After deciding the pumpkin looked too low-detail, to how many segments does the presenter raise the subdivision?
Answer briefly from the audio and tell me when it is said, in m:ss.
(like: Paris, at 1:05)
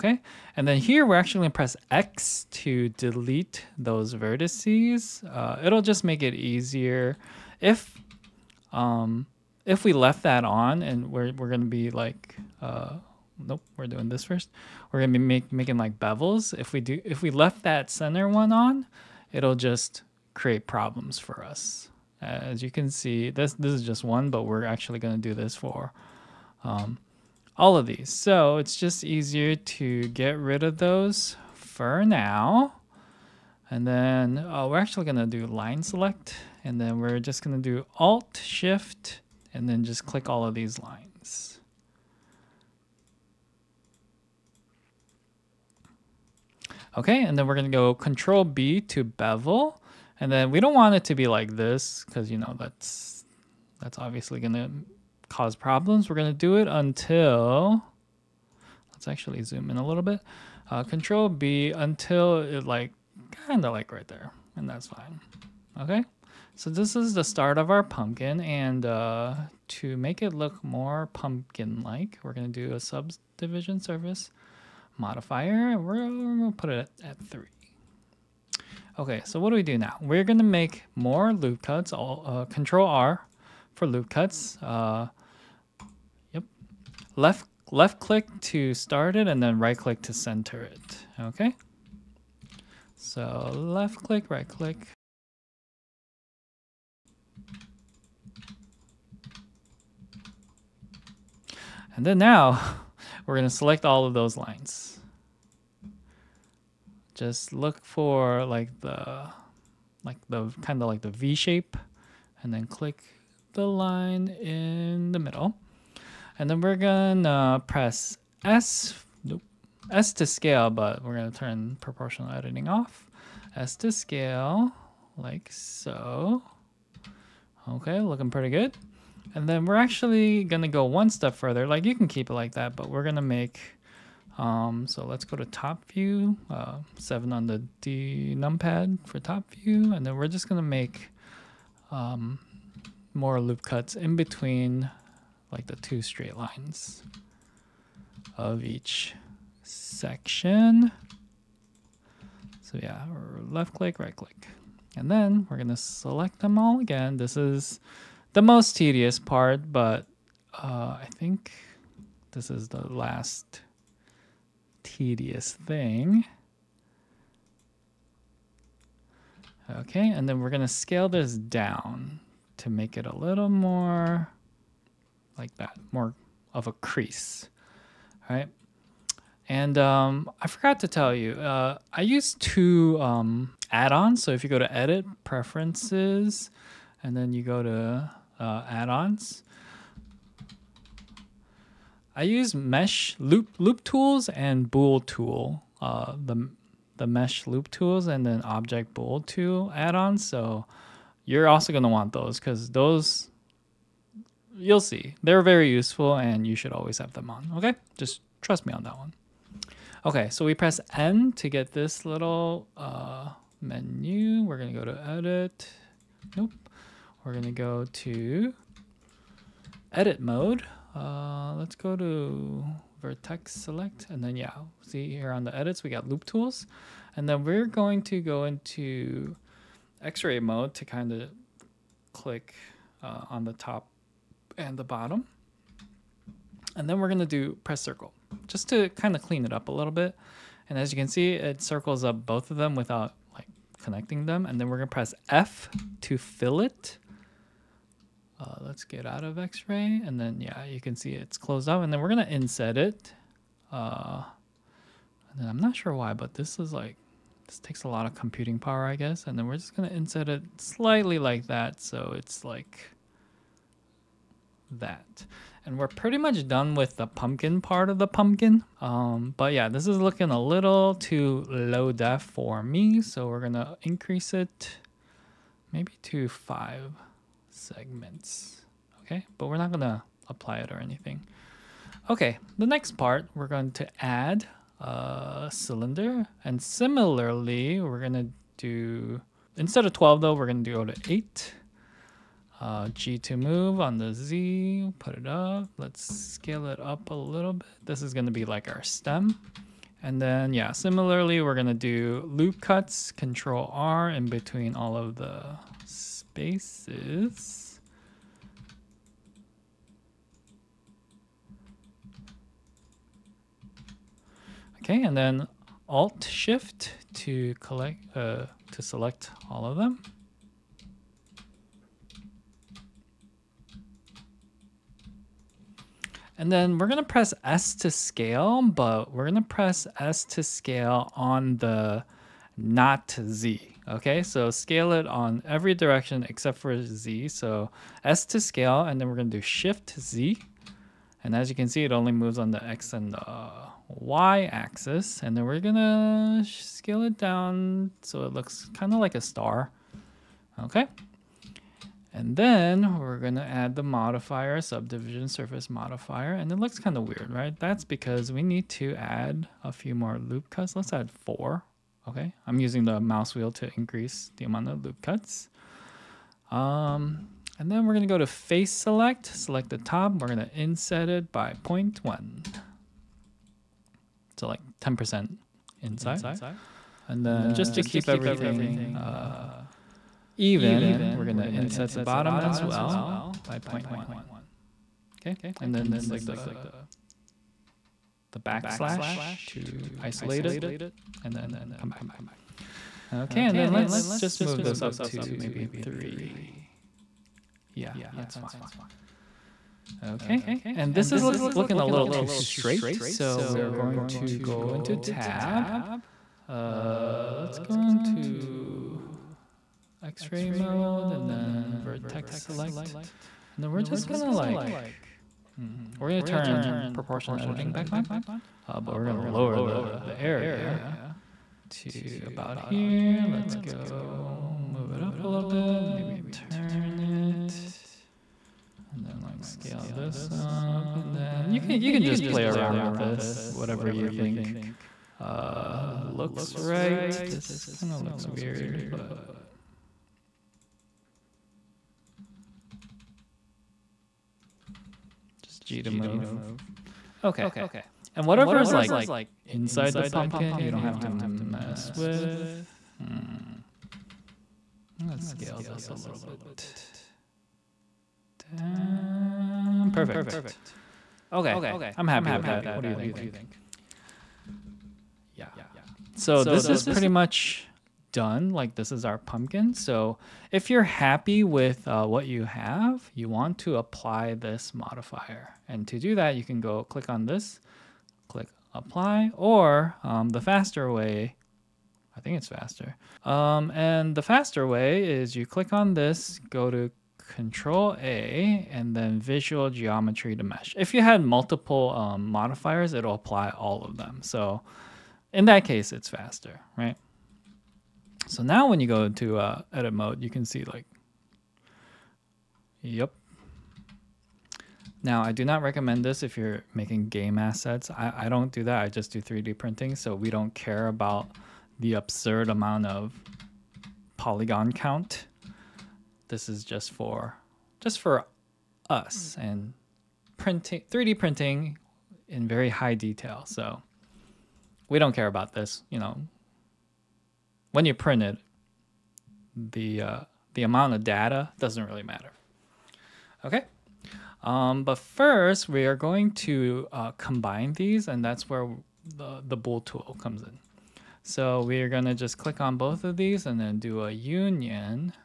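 5, at 4:36.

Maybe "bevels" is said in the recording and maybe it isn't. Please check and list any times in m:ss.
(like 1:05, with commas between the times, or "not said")
0:15, 0:49.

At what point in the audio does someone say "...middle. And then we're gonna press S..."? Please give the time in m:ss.
1:55.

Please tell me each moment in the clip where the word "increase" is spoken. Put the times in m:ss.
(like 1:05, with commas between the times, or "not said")
4:33, 6:03.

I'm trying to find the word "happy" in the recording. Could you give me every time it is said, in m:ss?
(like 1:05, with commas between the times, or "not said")
7:42, 7:50.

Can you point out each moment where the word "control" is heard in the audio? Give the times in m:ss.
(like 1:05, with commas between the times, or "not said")
0:47, 1:00, 1:22, 5:03, 8:07.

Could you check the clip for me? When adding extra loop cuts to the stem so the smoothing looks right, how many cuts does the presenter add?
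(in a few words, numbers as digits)
4.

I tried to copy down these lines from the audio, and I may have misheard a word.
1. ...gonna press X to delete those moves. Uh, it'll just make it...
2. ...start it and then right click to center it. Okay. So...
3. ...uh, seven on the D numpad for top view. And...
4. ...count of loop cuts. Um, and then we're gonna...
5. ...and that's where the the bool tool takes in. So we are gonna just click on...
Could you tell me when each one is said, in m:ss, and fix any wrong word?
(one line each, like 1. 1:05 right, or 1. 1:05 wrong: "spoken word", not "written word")
1. 0:01 wrong: "vertices", not "moves"
2. 1:28 right
3. 2:16 right
4. 6:04 wrong: "amount", not "count"
5. 8:58 wrong: "comes", not "takes".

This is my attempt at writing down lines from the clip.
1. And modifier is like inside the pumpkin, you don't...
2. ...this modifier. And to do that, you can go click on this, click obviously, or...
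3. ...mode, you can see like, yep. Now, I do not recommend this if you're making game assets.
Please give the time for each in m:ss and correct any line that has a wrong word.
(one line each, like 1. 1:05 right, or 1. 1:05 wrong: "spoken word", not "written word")
1. 7:28 wrong: "whatever", not "modifier"
2. 7:54 wrong: "apply", not "obviously"
3. 8:19 right.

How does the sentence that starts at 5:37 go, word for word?
So S to scale, and then we're gonna do Shift Z.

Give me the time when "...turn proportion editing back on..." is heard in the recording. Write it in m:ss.
6:56.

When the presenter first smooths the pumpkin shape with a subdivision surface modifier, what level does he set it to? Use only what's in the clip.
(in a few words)
3.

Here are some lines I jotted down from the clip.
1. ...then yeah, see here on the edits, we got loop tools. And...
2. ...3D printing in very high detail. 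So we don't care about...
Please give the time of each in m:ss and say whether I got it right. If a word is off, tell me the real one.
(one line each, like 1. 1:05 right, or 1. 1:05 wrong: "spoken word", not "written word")
1. 3:44 right
2. 8:40 right.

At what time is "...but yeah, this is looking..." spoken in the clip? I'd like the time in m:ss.
4:29.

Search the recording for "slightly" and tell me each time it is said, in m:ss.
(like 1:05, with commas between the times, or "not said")
4:20.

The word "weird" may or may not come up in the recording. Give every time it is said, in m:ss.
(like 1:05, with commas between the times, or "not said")
5:57, 7:18.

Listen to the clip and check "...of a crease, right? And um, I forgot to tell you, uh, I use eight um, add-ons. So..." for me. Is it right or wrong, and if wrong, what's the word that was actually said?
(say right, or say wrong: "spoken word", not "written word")
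wrong: "two", not "eight".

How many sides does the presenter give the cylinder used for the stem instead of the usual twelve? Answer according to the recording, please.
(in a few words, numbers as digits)
8.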